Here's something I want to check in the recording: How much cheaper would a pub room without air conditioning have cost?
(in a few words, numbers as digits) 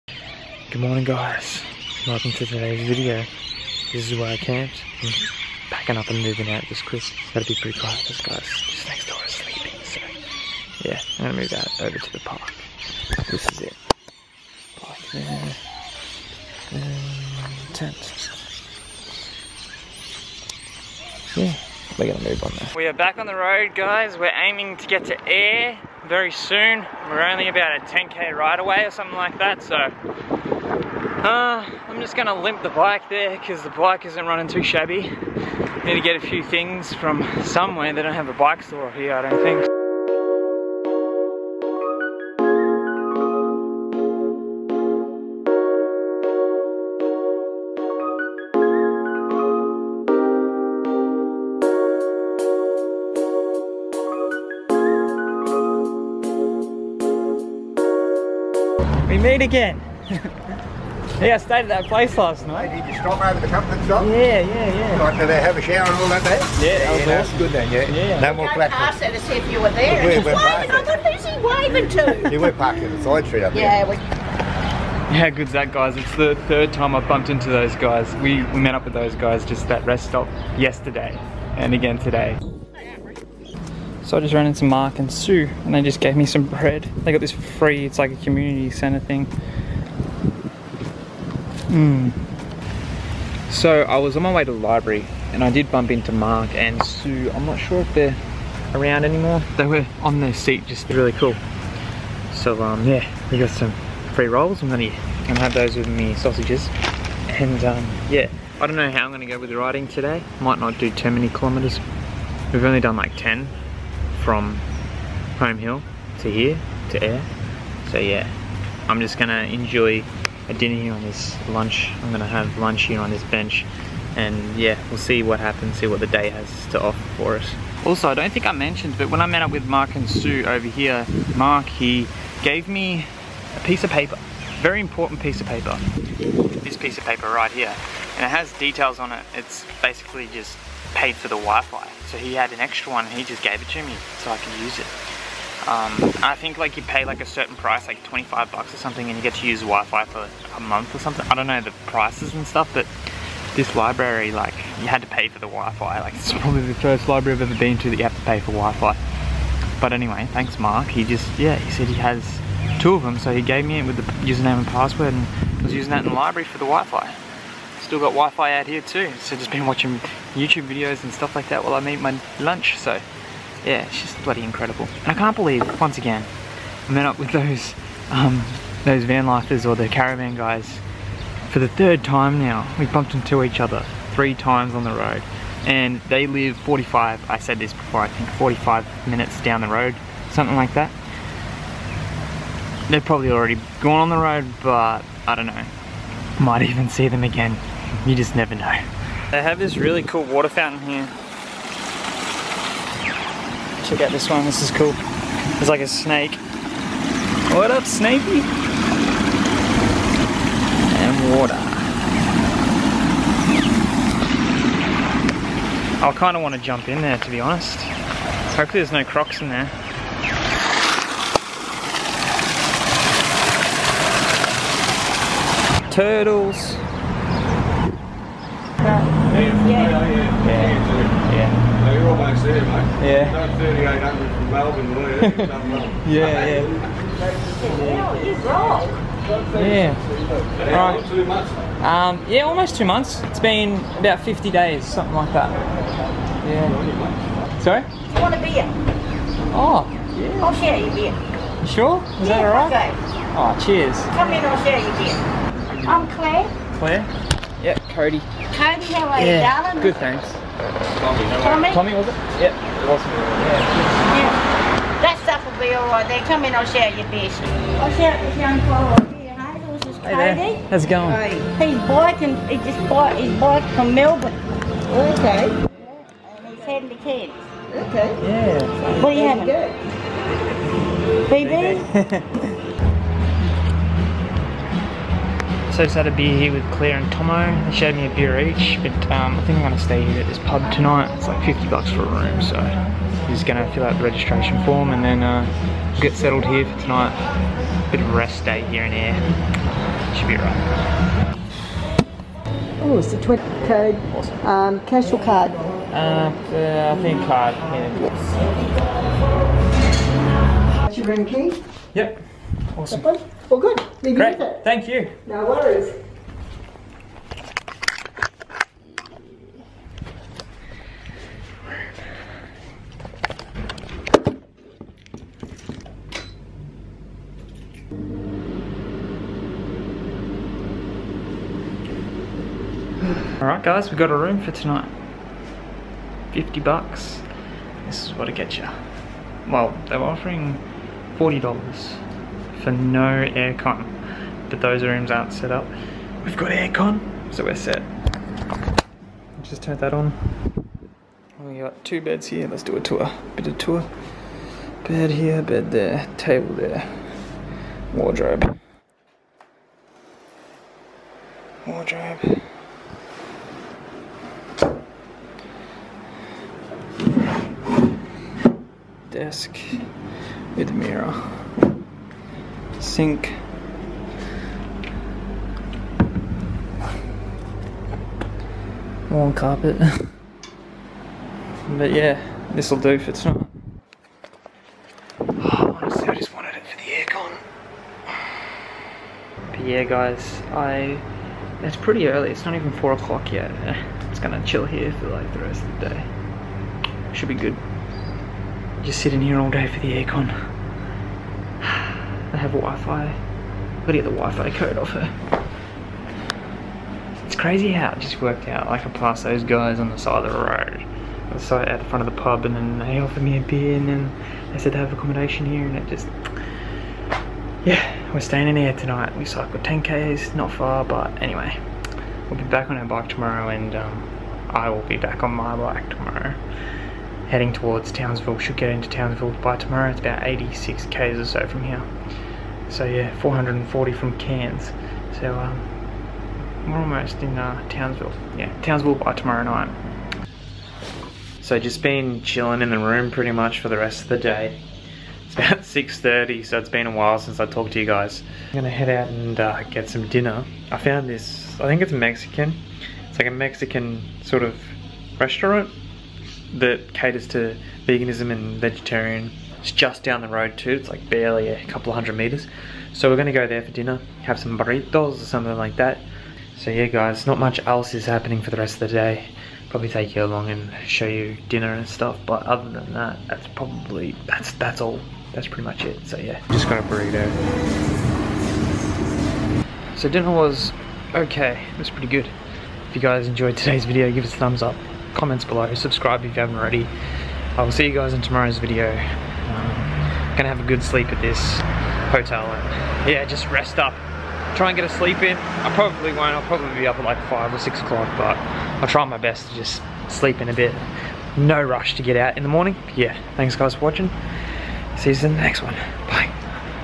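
$40.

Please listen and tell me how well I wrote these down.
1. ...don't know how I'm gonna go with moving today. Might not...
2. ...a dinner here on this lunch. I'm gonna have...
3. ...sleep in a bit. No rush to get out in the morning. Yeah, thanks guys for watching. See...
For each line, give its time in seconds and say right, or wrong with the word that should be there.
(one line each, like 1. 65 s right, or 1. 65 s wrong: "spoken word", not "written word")
1. 108 s wrong: "riding", not "moving"
2. 120 s right
3. 500 s right.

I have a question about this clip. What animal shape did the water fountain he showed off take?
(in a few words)
A snake.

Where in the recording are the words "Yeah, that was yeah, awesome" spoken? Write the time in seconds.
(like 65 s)
66 s.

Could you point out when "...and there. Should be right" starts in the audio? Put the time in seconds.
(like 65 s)
298 s.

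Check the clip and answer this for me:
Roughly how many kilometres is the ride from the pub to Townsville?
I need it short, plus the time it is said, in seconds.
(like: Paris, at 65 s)
86, at 430 s.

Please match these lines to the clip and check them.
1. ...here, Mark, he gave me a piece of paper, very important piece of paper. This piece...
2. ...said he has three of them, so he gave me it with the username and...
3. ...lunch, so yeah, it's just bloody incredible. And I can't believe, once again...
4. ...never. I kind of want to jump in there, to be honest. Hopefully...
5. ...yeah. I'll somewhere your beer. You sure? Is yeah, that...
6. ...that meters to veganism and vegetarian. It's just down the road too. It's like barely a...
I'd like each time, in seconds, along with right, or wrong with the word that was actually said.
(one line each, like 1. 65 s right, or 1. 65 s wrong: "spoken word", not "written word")
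1. 130 s right
2. 161 s wrong: "two", not "three"
3. 172 s right
4. 211 s wrong: "water", not "never"
5. 250 s wrong: "share", not "somewhere"
6. 456 s wrong: "caters", not "meters".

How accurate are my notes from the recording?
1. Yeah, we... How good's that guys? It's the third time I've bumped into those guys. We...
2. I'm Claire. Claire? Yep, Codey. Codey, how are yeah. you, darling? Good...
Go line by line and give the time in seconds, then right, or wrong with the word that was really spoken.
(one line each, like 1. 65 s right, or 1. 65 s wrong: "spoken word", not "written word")
1. 73 s right
2. 255 s right.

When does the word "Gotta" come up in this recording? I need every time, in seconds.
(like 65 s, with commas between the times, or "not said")
7 s, 403 s.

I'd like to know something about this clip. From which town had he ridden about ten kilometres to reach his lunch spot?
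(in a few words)
Home Hill.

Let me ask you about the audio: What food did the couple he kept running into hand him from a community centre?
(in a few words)
Bread.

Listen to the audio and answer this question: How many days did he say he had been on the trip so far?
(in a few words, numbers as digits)
About 50.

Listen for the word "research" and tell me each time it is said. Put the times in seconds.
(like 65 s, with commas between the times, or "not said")
not said.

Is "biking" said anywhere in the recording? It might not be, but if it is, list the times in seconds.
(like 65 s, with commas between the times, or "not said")
271 s.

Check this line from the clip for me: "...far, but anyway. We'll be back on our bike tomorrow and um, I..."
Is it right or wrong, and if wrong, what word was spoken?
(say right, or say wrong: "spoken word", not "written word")
right.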